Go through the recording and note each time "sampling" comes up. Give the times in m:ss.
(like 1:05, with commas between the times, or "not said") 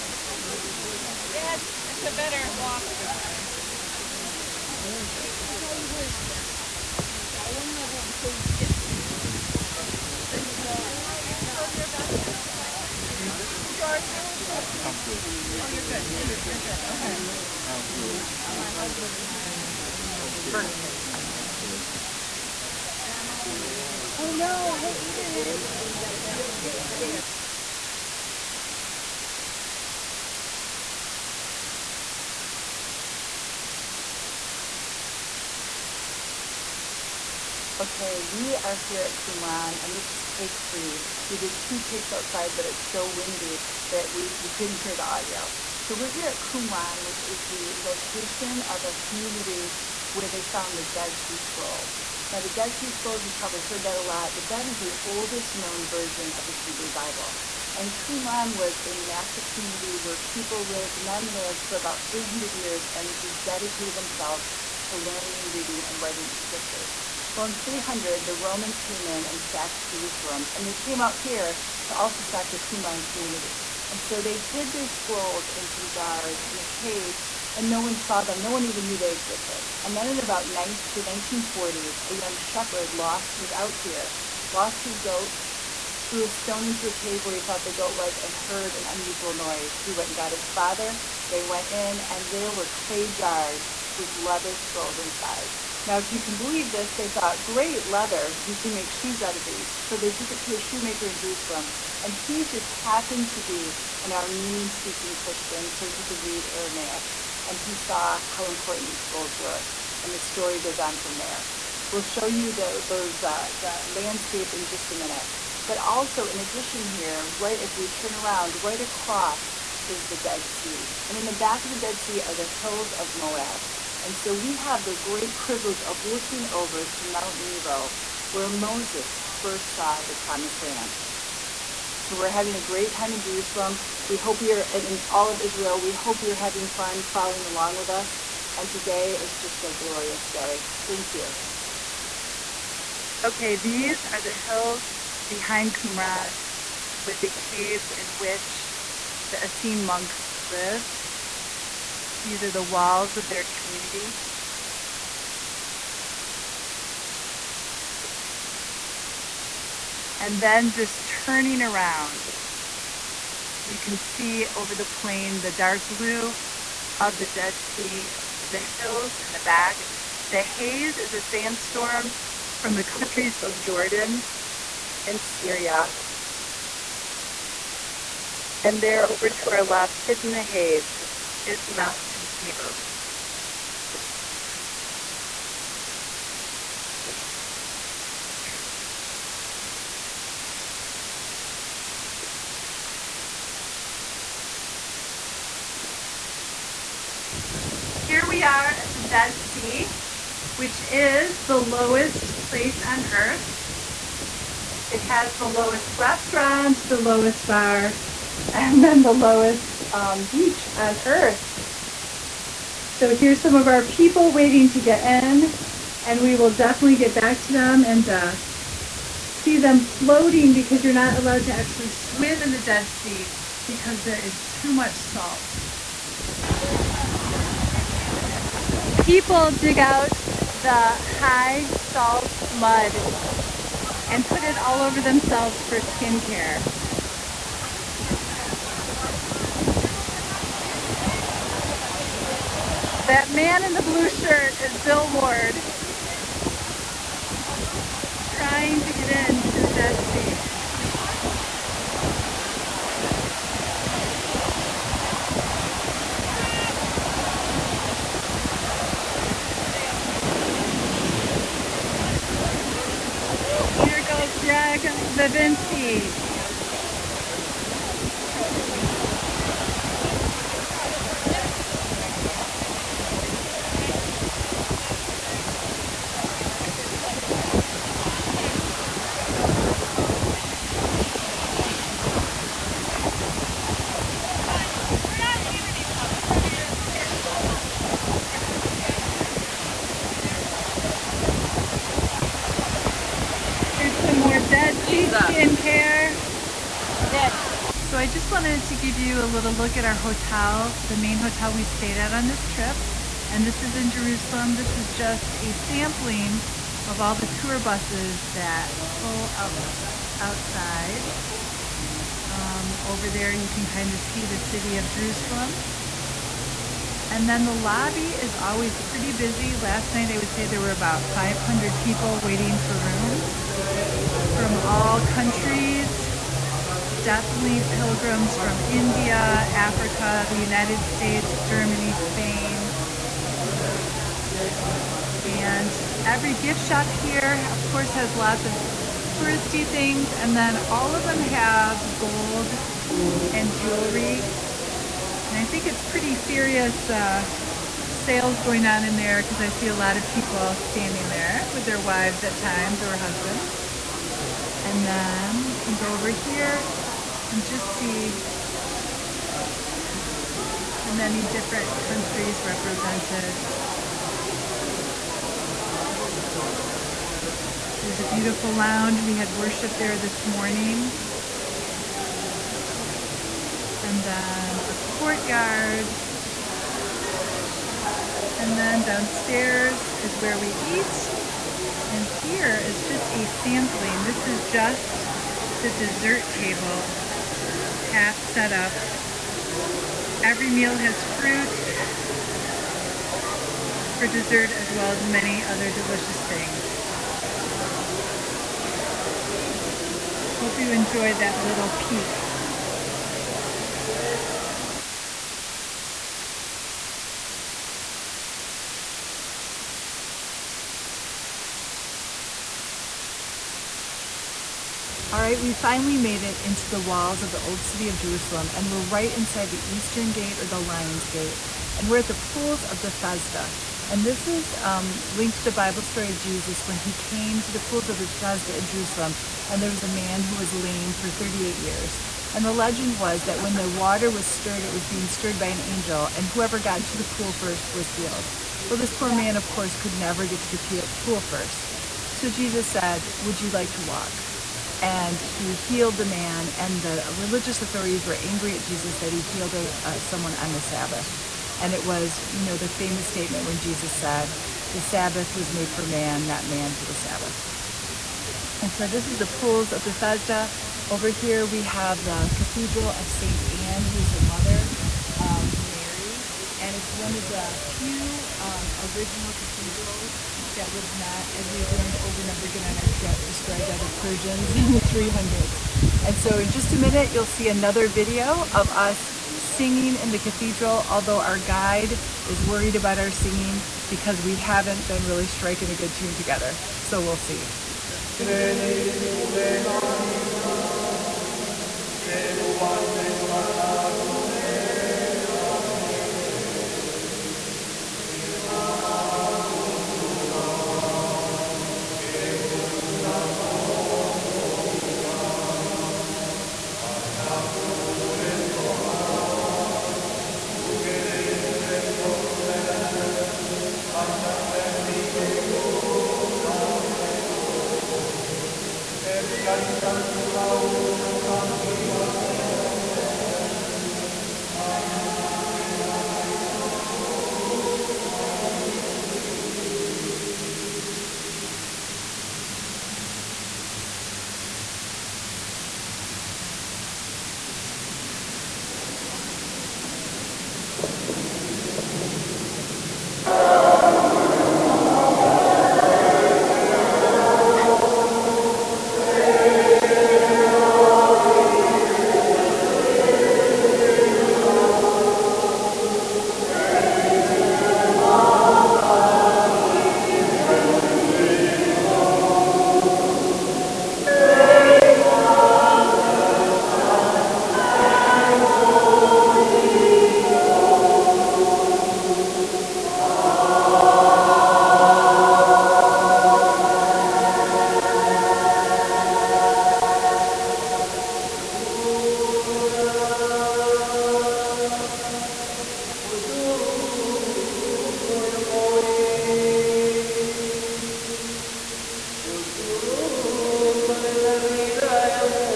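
5:05, 6:23.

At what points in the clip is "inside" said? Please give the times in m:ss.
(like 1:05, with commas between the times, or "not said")
1:34, 6:59.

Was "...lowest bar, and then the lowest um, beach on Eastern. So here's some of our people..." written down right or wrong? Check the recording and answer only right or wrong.
wrong.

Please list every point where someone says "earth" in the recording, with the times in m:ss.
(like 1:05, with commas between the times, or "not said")
3:23, 3:31.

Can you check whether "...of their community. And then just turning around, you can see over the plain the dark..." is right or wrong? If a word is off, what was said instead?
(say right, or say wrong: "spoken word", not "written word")
right.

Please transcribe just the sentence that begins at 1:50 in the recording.
And the story goes on from there.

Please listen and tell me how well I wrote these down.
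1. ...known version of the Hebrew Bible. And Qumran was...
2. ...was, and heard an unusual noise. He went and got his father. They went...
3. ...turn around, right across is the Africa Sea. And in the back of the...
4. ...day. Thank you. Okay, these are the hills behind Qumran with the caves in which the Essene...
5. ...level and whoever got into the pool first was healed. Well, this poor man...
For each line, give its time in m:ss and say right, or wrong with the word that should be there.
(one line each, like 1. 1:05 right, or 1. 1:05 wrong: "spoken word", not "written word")
1. 0:55 right
2. 1:27 right
3. 1:57 wrong: "Dead", not "Africa"
4. 2:20 right
5. 7:15 wrong: "angel", not "level".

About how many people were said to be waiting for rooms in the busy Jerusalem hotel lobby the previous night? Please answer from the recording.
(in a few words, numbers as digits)
500.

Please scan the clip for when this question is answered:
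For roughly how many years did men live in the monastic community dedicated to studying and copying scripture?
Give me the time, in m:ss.
1:01.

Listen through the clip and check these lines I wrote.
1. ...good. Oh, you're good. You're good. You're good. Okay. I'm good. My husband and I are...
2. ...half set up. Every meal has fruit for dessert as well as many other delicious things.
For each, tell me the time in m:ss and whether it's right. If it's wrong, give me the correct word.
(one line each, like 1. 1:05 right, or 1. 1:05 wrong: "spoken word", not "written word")
1. 0:15 right
2. 6:27 right.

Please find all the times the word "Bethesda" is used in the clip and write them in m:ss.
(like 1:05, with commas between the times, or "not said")
7:02, 7:07, 7:39.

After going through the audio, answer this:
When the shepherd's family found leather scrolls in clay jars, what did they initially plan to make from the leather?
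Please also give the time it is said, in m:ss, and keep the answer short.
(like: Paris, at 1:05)
shoes, at 1:38.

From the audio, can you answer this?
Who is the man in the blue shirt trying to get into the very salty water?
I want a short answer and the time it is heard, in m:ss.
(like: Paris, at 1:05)
Bill Ward, at 4:04.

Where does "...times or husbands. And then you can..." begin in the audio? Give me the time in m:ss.
5:52.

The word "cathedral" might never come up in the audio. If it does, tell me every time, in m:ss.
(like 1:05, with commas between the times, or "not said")
7:42, 7:49, 8:00.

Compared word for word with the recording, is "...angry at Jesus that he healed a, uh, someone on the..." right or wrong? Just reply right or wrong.
right.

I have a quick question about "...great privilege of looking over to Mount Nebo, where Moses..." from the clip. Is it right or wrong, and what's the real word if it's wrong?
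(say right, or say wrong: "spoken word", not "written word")
right.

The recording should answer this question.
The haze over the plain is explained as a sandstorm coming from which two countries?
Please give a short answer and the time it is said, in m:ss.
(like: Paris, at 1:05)
Jordan and Syria, at 2:53.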